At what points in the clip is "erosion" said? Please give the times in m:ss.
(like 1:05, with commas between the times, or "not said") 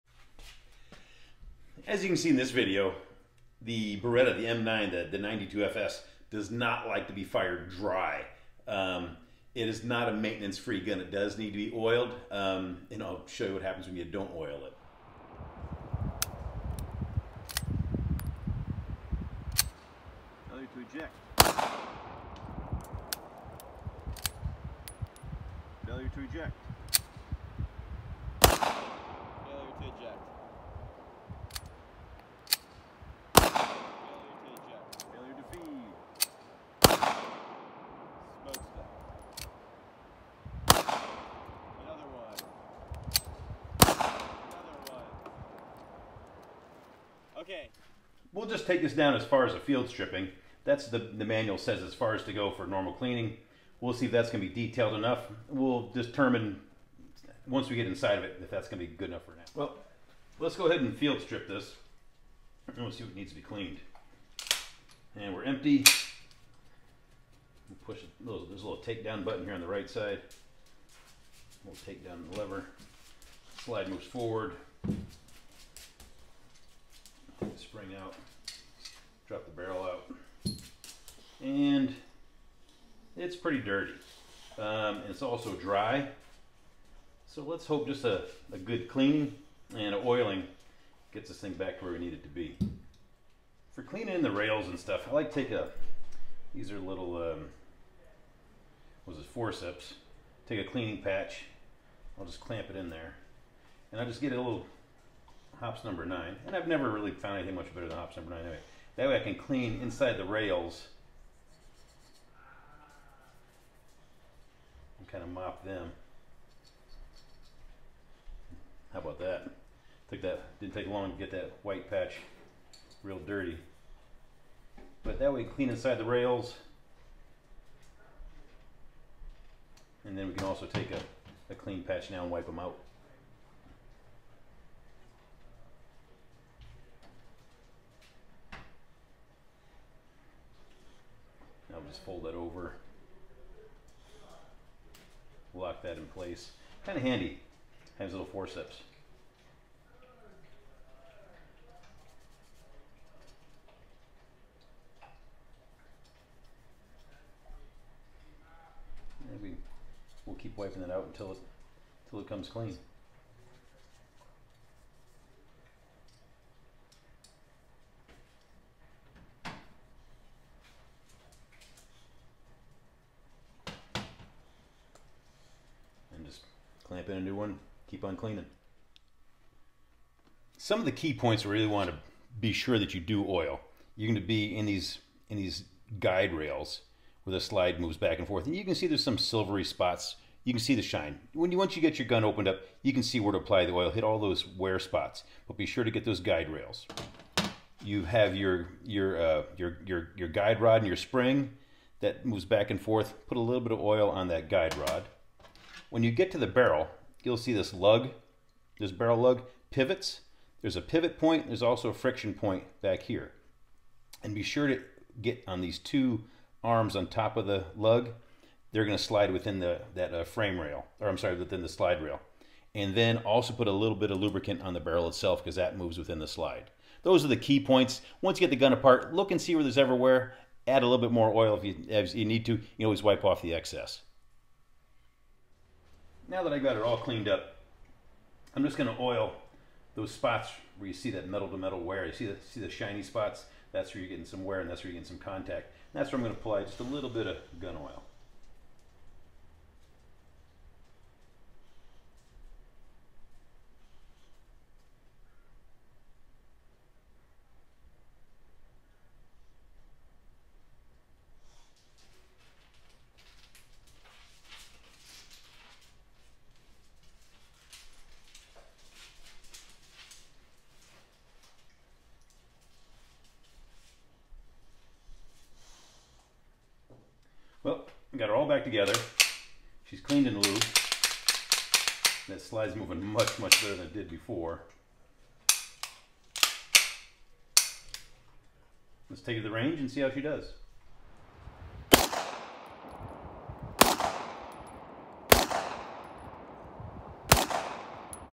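not said.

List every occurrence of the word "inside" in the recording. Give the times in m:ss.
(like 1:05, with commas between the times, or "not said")
0:57, 1:49, 2:05.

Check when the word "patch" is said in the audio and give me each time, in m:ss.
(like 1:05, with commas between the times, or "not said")
1:41, 2:01, 2:11.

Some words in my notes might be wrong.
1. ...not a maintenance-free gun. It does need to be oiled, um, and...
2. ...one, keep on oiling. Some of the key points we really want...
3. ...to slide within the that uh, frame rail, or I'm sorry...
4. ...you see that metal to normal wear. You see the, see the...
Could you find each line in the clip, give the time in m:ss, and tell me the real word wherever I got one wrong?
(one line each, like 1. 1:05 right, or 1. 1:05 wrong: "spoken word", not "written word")
1. 0:09 right
2. 2:57 wrong: "cleaning", not "oiling"
3. 3:38 right
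4. 4:00 wrong: "metal", not "normal".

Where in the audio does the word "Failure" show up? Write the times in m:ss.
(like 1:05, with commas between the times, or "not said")
0:20, 0:25.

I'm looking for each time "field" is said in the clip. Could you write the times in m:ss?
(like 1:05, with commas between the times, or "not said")
0:49, 1:00.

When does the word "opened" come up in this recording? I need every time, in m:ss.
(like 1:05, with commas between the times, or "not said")
3:12.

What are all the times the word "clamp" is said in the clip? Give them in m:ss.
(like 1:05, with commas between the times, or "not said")
1:42, 2:56.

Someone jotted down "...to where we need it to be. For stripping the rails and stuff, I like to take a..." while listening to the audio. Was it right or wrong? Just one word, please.
wrong.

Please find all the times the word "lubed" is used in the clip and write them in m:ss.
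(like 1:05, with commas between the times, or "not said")
4:40.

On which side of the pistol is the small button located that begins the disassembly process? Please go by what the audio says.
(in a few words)
Right side.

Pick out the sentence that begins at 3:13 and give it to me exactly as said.
Hit all those wear spots, but be sure to get those guide rails.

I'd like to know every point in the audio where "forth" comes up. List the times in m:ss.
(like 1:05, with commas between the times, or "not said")
3:08, 3:22.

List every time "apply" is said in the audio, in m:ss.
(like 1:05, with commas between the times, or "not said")
3:13, 4:06.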